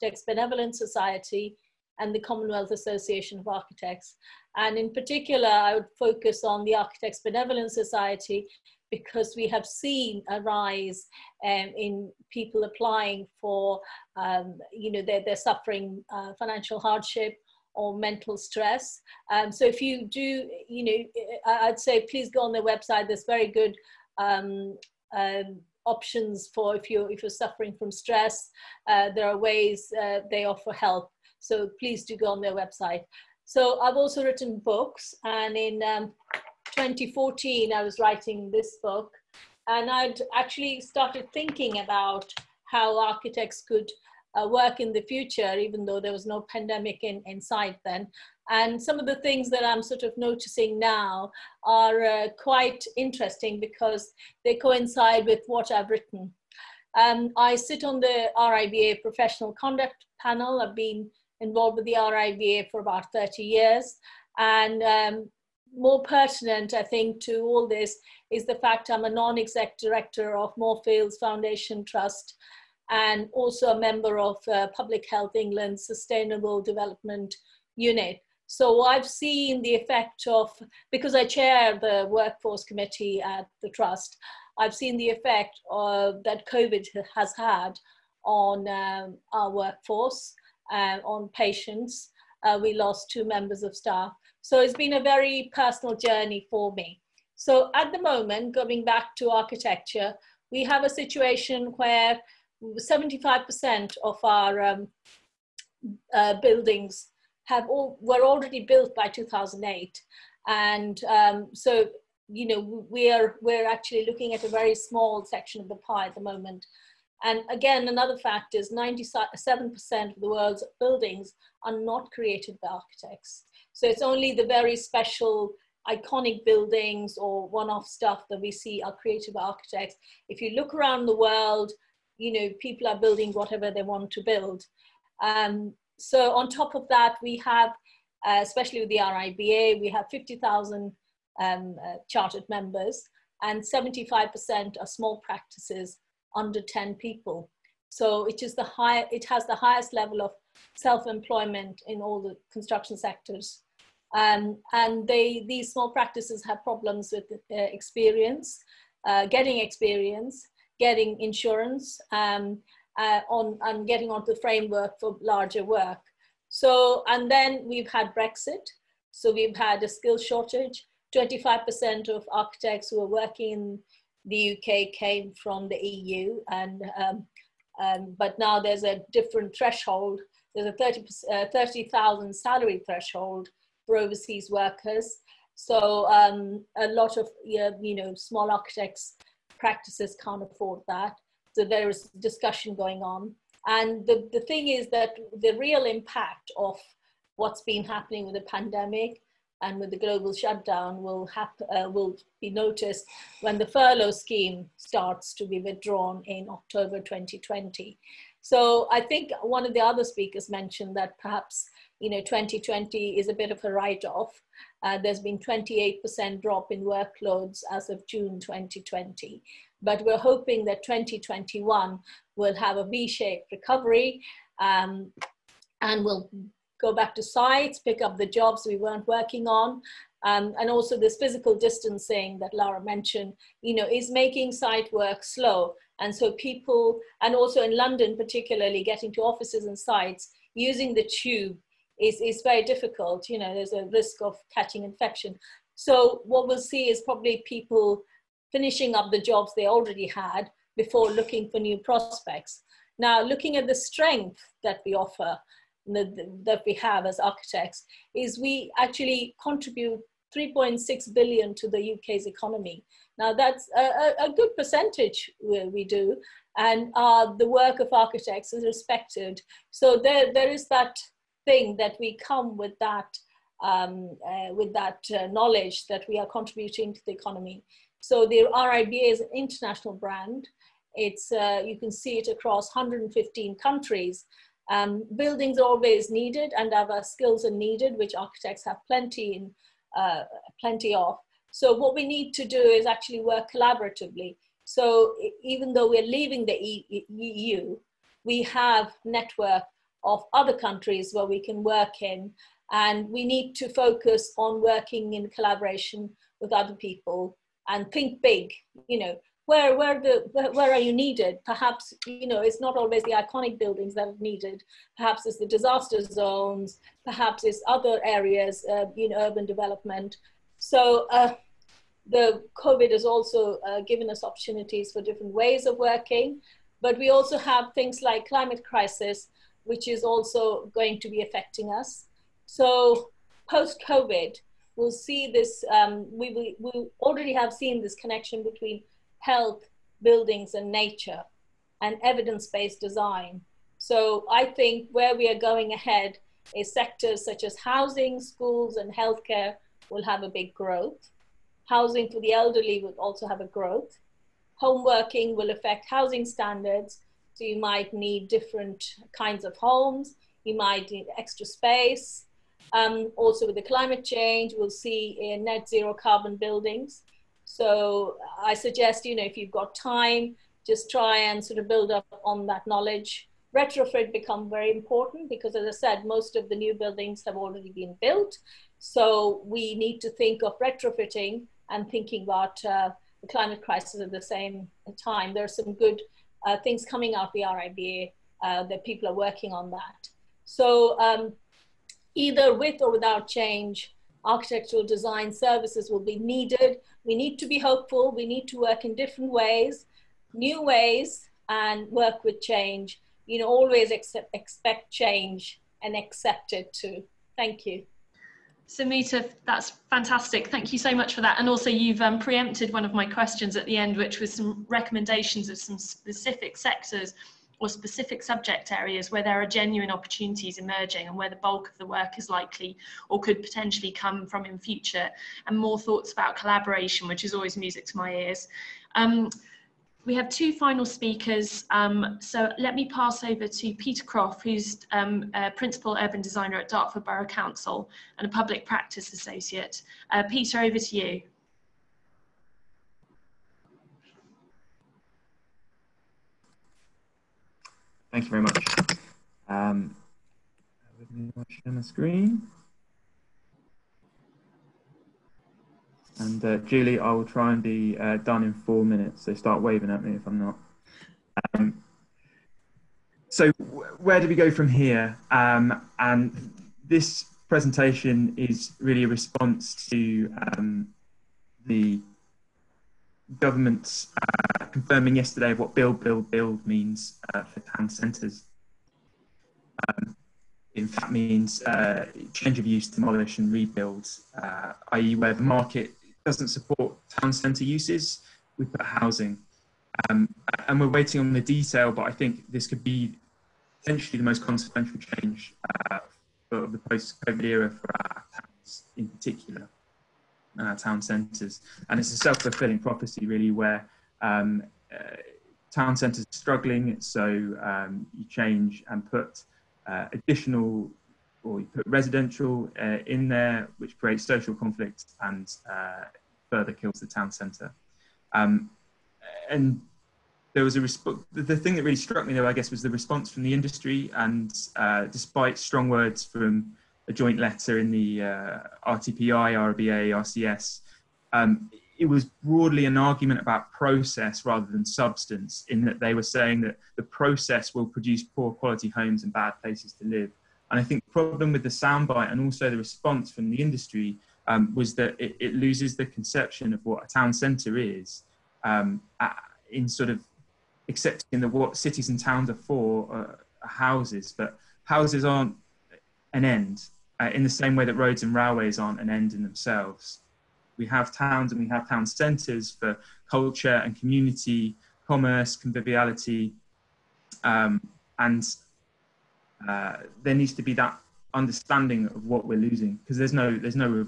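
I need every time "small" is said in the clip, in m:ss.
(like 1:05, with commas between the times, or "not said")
1:54, 2:24, 2:35, 3:08.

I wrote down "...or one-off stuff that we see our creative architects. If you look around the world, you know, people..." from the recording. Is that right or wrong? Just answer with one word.
right.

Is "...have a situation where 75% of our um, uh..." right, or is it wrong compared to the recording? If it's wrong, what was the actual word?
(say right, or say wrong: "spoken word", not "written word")
right.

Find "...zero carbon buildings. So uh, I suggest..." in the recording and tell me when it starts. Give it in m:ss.
6:05.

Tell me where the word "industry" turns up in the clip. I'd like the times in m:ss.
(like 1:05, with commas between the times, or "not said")
8:43, 9:03.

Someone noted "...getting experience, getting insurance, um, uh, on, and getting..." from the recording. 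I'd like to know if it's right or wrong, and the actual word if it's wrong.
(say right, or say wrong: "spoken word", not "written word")
right.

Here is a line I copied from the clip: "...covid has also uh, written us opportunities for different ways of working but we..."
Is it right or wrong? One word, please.
wrong.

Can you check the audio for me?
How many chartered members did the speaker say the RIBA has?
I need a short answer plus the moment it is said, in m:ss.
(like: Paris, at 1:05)
50,000, at 2:20.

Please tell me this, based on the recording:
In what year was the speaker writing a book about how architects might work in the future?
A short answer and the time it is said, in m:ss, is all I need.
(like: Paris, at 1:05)
2014, at 0:36.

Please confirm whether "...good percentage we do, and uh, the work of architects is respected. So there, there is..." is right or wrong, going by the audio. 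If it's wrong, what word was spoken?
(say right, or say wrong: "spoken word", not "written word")
right.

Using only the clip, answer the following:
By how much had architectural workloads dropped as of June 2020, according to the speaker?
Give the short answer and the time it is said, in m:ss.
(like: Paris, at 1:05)
28%, at 3:35.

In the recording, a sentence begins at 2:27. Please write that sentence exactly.
So it is the high, it has the highest level of self-employment in all the construction sectors.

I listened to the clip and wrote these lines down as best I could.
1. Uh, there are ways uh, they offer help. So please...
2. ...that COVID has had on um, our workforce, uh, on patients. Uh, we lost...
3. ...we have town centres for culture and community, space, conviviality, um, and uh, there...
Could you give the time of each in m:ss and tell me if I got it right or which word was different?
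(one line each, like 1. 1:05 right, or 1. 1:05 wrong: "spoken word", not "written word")
1. 0:28 right
2. 1:26 right
3. 9:21 wrong: "commerce", not "space".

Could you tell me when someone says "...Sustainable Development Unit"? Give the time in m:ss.
1:15.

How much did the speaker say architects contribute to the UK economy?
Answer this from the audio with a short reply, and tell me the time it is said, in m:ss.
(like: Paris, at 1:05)
3.6 billion, at 4:20.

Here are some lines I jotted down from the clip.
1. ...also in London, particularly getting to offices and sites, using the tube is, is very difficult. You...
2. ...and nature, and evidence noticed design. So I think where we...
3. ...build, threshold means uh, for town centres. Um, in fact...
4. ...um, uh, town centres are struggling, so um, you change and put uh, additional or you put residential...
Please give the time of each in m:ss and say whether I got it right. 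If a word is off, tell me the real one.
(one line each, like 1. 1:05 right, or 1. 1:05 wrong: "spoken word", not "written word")
1. 3:57 right
2. 5:40 wrong: "based", not "noticed"
3. 7:56 wrong: "build", not "threshold"
4. 8:24 right.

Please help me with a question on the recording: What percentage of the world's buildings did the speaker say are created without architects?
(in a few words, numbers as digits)
97%.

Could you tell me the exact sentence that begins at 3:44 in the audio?
Um, and will go back to sites, pick up the jobs we weren't working on.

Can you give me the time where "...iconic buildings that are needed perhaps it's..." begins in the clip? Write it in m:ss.
5:13.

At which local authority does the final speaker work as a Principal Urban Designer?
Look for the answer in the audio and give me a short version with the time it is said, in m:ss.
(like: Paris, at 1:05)
Dartford Borough Council, at 7:16.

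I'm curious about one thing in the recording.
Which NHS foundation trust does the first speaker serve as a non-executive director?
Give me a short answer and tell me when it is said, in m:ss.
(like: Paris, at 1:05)
Moorfields, at 1:10.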